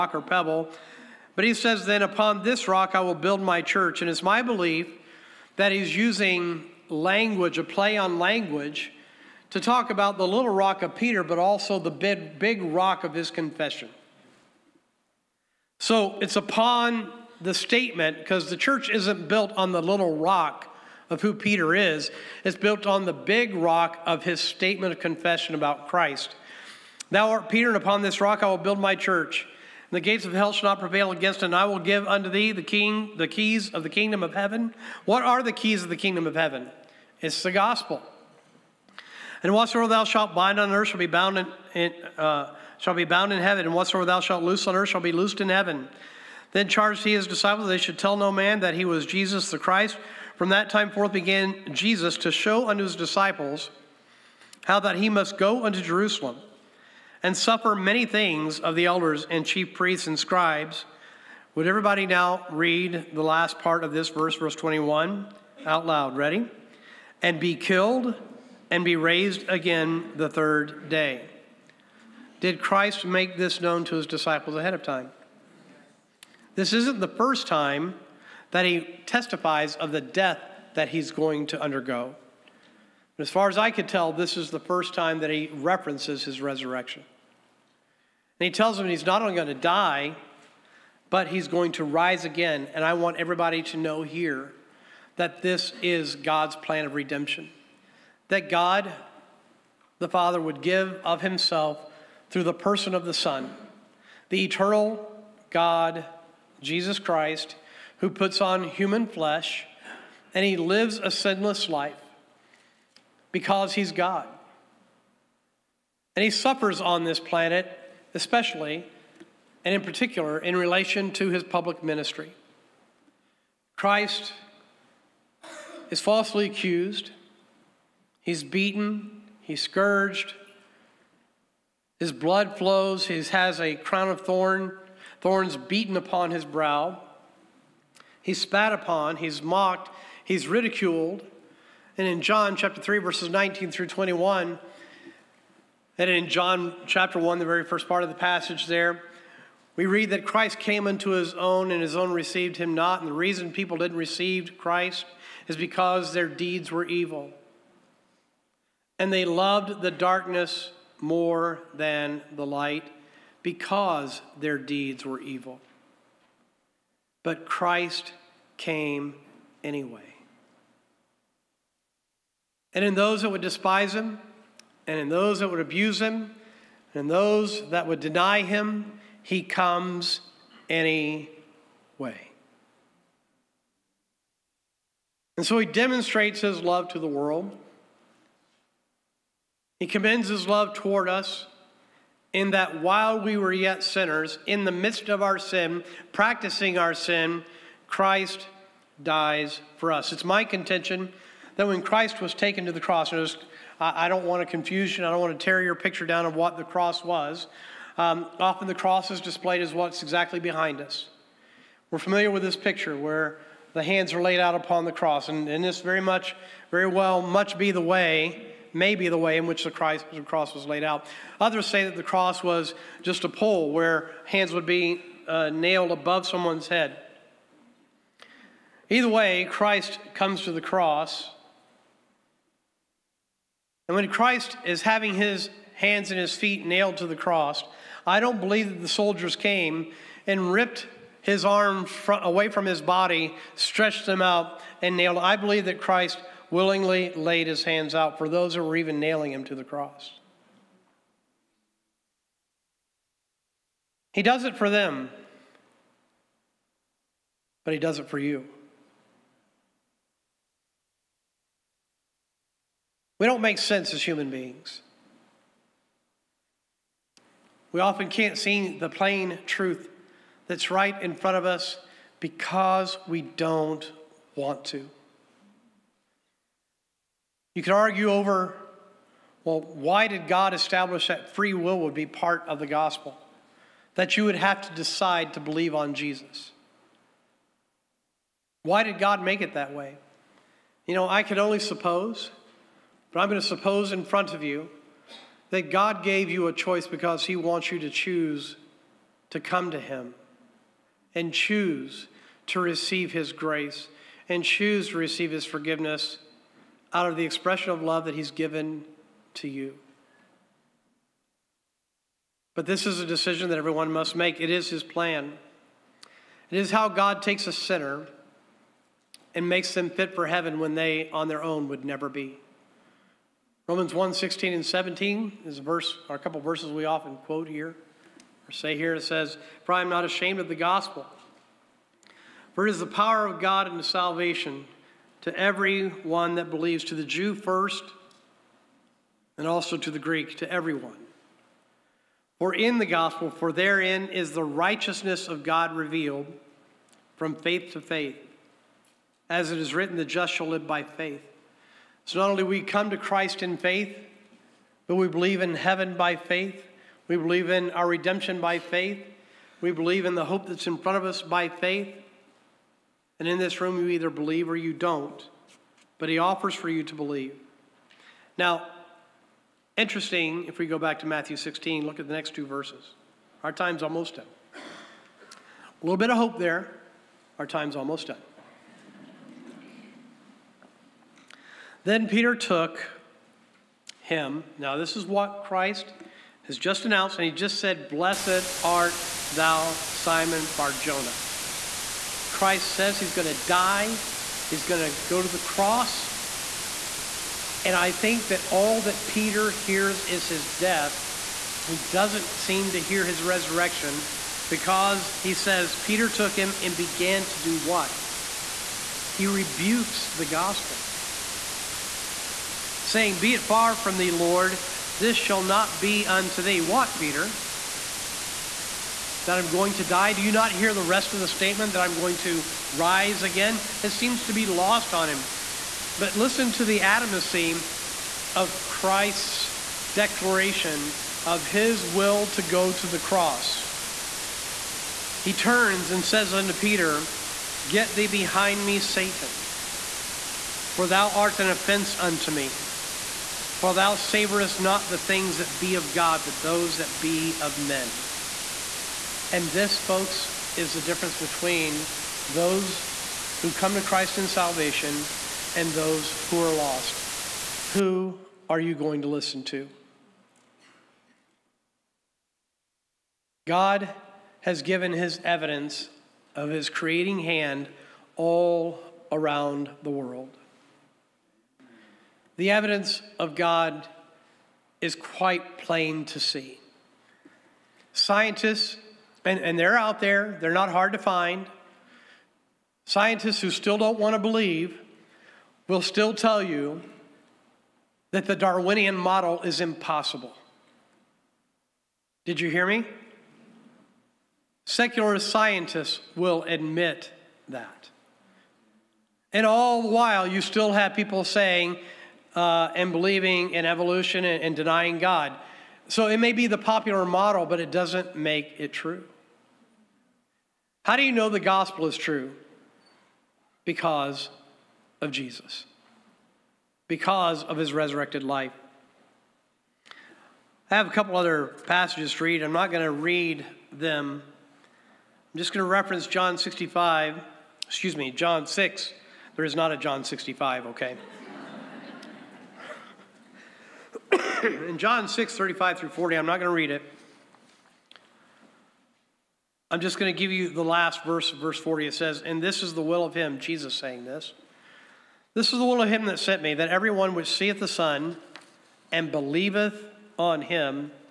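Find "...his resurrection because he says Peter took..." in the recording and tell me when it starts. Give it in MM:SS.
06:43.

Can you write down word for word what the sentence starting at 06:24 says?
Now, this is what Christ has just announced, and he just said, Blessed art thou, Simon Barjona.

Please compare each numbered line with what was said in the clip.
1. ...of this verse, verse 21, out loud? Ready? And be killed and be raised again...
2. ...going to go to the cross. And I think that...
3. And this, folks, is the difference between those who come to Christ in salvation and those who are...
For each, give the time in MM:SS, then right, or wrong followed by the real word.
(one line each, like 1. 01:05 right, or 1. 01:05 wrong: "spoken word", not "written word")
1. 01:03 right
2. 06:34 right
3. 07:29 right.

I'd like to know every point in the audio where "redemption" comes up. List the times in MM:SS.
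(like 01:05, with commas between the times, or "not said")
01:36, 05:57.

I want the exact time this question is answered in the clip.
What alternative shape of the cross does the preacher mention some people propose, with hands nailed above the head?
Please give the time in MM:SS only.
03:43.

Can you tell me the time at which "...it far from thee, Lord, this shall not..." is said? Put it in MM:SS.
06:53.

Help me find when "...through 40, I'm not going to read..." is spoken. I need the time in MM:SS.
08:55.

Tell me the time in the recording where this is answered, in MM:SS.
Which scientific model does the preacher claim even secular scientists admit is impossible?
08:08.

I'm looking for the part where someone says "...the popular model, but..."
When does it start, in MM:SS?
08:26.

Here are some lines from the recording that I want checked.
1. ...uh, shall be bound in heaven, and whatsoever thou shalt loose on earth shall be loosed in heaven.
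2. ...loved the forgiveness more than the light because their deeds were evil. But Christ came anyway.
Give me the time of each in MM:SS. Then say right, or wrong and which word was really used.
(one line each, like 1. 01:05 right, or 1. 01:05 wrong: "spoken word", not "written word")
1. 00:42 right
2. 02:39 wrong: "darkness", not "forgiveness".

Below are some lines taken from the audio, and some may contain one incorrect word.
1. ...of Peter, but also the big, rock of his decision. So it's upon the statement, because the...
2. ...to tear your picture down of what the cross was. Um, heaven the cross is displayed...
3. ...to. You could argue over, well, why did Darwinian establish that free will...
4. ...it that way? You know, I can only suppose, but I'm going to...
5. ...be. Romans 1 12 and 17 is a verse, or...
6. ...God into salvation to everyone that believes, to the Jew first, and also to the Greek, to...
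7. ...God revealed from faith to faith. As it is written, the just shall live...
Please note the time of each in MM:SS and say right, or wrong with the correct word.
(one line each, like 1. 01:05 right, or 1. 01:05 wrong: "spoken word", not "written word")
1. 00:10 wrong: "confession", not "decision"
2. 03:25 wrong: "often", not "heaven"
3. 04:34 wrong: "God", not "Darwinian"
4. 04:49 right
5. 05:22 wrong: "16", not "12"
6. 05:33 right
7. 05:45 right.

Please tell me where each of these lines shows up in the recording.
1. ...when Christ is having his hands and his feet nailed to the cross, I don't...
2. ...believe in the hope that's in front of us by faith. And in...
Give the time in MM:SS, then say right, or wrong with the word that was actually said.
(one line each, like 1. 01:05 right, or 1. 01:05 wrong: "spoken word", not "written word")
1. 03:53 right
2. 05:59 right.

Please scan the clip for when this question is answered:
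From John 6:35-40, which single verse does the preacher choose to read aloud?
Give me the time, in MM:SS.
09:01.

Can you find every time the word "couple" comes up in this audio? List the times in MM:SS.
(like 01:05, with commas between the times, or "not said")
05:26, 08:40.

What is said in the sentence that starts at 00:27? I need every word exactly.
Thou art Peter, and upon this rock I will build my church.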